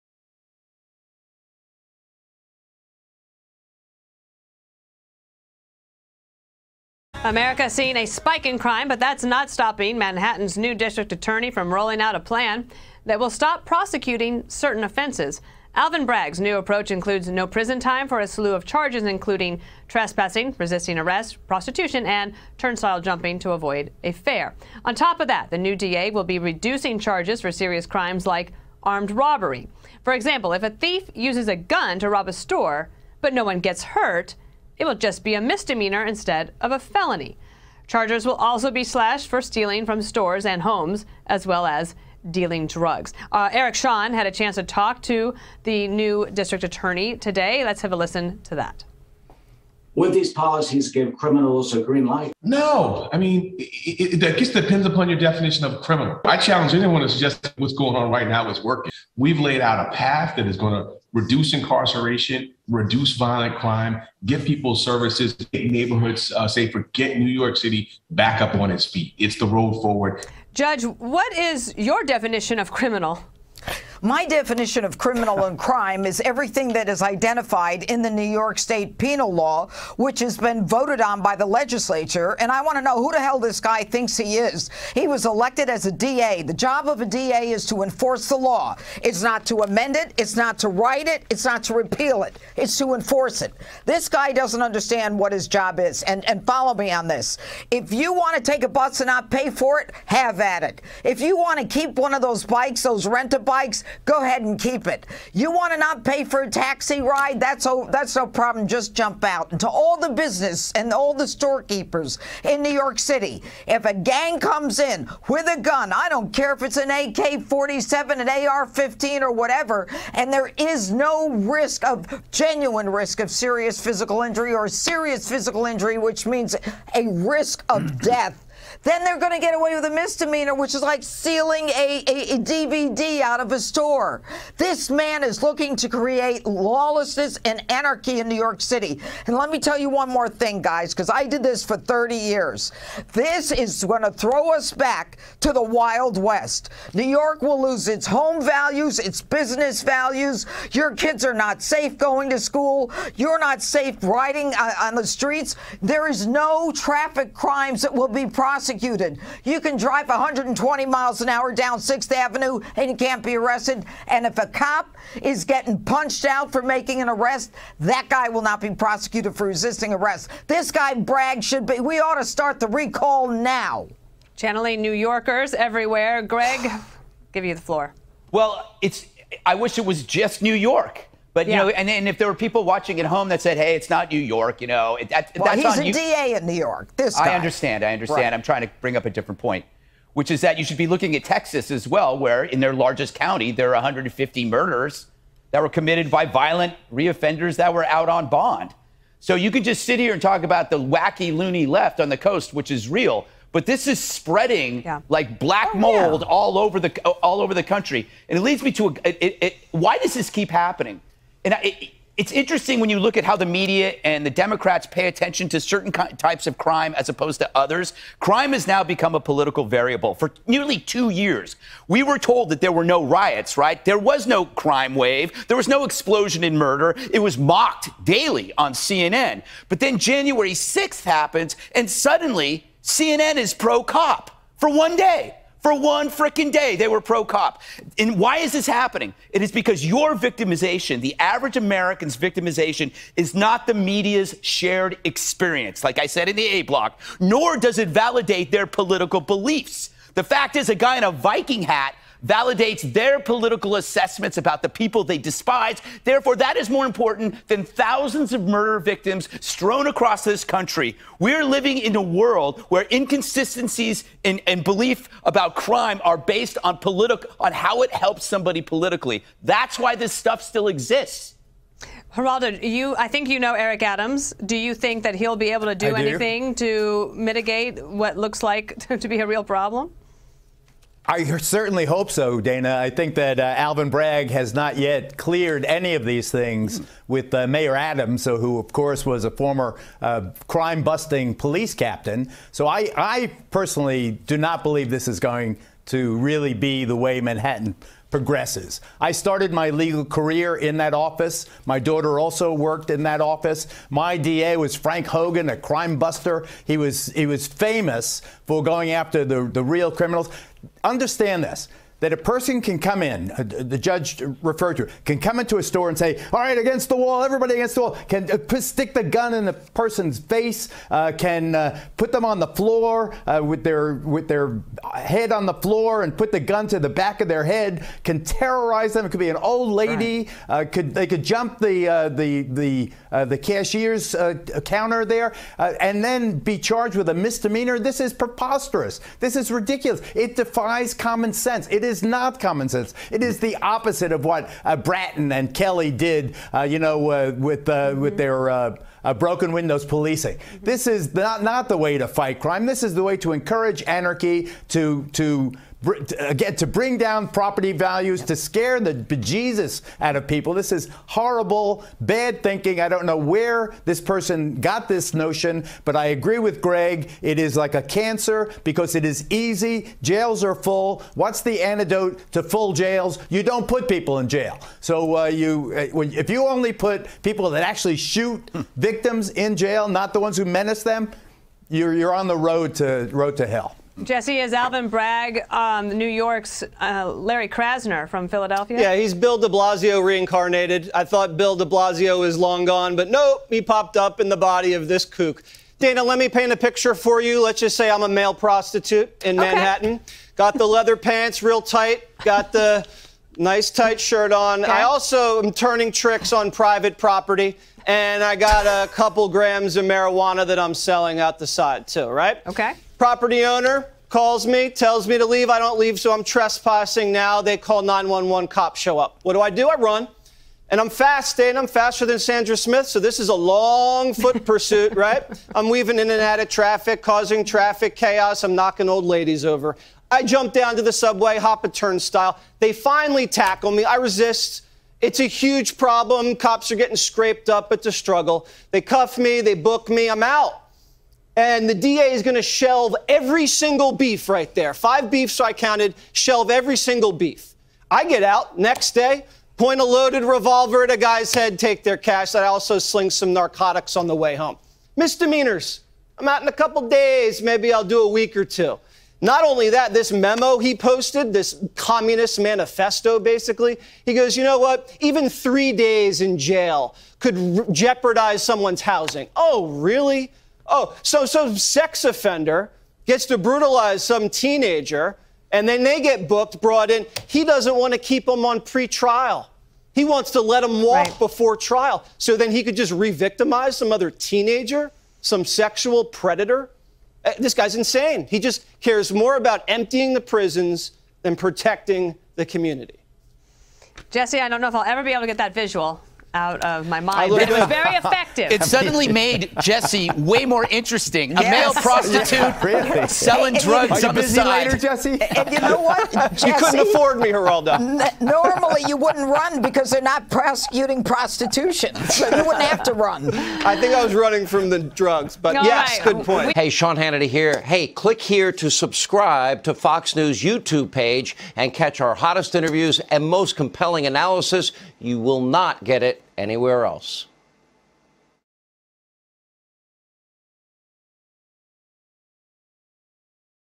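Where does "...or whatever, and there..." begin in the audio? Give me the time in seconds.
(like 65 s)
119 s.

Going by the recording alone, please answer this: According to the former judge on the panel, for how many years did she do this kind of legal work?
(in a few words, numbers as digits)
30 years.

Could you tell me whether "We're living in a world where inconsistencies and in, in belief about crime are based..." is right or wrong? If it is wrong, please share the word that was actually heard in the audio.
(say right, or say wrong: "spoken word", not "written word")
right.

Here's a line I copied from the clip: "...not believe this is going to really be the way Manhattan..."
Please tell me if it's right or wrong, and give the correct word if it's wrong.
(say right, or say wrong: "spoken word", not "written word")
right.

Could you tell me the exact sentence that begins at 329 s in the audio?
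It could be an old lady, right.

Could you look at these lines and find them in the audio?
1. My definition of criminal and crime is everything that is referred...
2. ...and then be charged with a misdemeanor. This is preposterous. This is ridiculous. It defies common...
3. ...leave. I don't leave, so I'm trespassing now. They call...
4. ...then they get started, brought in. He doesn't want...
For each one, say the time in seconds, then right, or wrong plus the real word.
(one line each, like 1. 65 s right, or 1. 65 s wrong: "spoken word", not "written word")
1. 74 s wrong: "identified", not "referred"
2. 335 s right
3. 415 s right
4. 475 s wrong: "booked", not "started".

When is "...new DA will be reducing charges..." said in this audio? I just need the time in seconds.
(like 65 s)
25 s.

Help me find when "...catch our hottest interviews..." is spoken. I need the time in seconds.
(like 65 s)
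521 s.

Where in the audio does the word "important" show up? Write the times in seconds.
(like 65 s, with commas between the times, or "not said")
256 s.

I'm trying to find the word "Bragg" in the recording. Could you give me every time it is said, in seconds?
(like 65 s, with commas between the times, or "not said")
16 s, 170 s, 283 s, 384 s.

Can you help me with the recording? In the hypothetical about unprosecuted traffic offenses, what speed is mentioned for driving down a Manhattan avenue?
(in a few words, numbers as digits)
120 miles an hour.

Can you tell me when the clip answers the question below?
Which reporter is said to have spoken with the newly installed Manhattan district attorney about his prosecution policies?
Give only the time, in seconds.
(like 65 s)
43 s.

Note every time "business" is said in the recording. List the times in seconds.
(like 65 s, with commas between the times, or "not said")
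110 s, 149 s.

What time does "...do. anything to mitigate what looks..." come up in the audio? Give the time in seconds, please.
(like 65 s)
275 s.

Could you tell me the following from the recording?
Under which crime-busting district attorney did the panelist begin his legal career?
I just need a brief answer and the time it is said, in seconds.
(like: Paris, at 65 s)
Frank Hogan, at 304 s.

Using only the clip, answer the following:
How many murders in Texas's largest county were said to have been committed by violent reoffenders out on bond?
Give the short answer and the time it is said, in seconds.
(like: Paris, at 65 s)
150, at 193 s.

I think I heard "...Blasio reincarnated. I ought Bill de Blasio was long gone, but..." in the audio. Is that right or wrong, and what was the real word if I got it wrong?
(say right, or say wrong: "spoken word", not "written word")
wrong: "thought", not "ought".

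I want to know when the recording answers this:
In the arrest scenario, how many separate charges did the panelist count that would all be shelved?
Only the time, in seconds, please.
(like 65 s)
444 s.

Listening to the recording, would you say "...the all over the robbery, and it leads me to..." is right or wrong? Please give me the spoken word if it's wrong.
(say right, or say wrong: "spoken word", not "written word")
wrong: "country", not "robbery".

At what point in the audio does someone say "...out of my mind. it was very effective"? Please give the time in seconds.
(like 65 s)
496 s.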